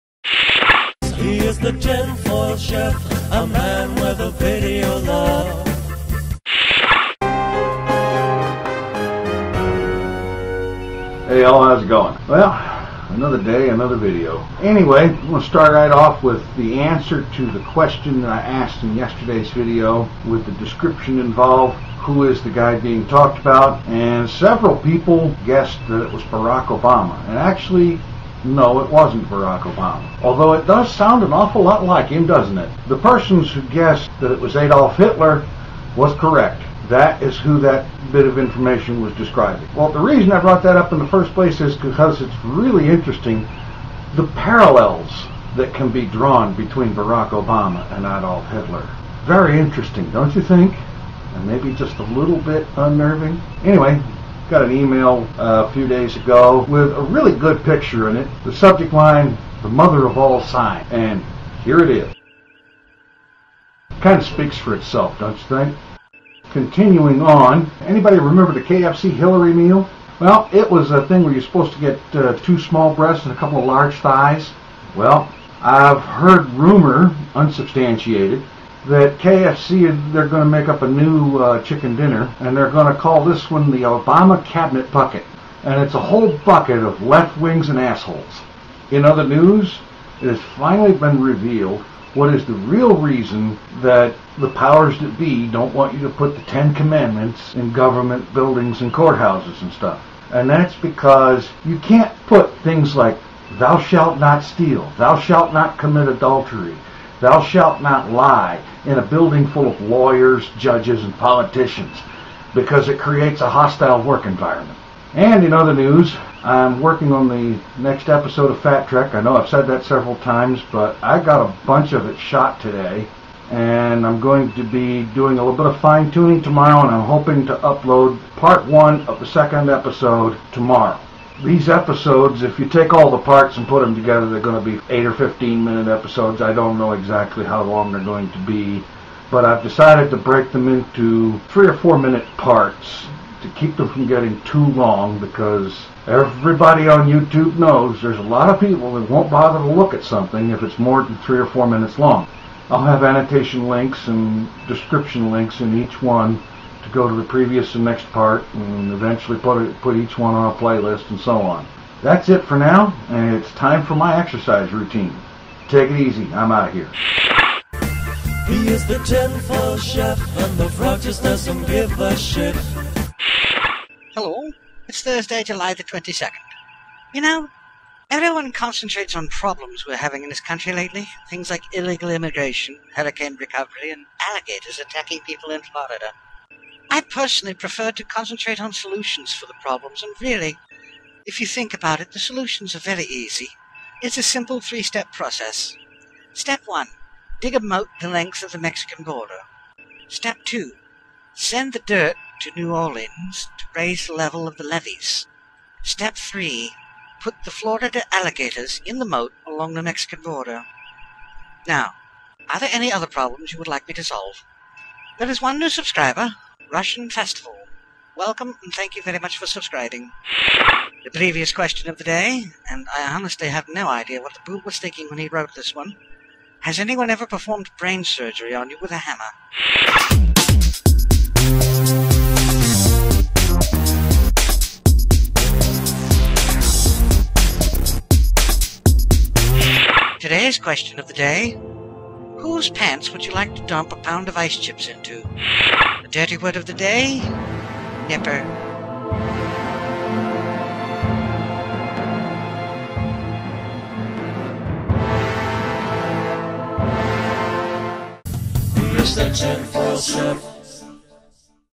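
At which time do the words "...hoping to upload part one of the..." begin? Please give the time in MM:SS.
02:07.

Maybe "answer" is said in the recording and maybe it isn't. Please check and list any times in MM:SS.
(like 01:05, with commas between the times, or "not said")
00:16.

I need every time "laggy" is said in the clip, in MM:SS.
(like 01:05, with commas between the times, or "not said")
not said.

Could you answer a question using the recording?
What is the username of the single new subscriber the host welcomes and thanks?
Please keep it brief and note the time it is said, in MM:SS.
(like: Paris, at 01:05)
Russian Festival, at 03:36.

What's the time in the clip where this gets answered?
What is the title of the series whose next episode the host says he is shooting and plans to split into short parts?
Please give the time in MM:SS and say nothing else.
01:58.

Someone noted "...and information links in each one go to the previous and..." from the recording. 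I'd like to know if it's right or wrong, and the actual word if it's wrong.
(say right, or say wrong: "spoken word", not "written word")
wrong: "description", not "information".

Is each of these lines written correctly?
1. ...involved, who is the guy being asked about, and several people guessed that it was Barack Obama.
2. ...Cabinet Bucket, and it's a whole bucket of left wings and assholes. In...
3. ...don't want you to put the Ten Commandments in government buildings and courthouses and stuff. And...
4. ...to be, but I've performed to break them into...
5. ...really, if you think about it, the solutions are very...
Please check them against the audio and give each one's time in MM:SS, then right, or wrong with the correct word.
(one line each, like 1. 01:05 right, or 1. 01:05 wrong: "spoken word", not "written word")
1. 00:21 wrong: "talked", not "asked"
2. 01:24 right
3. 01:35 right
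4. 02:18 wrong: "decided", not "performed"
5. 03:10 right.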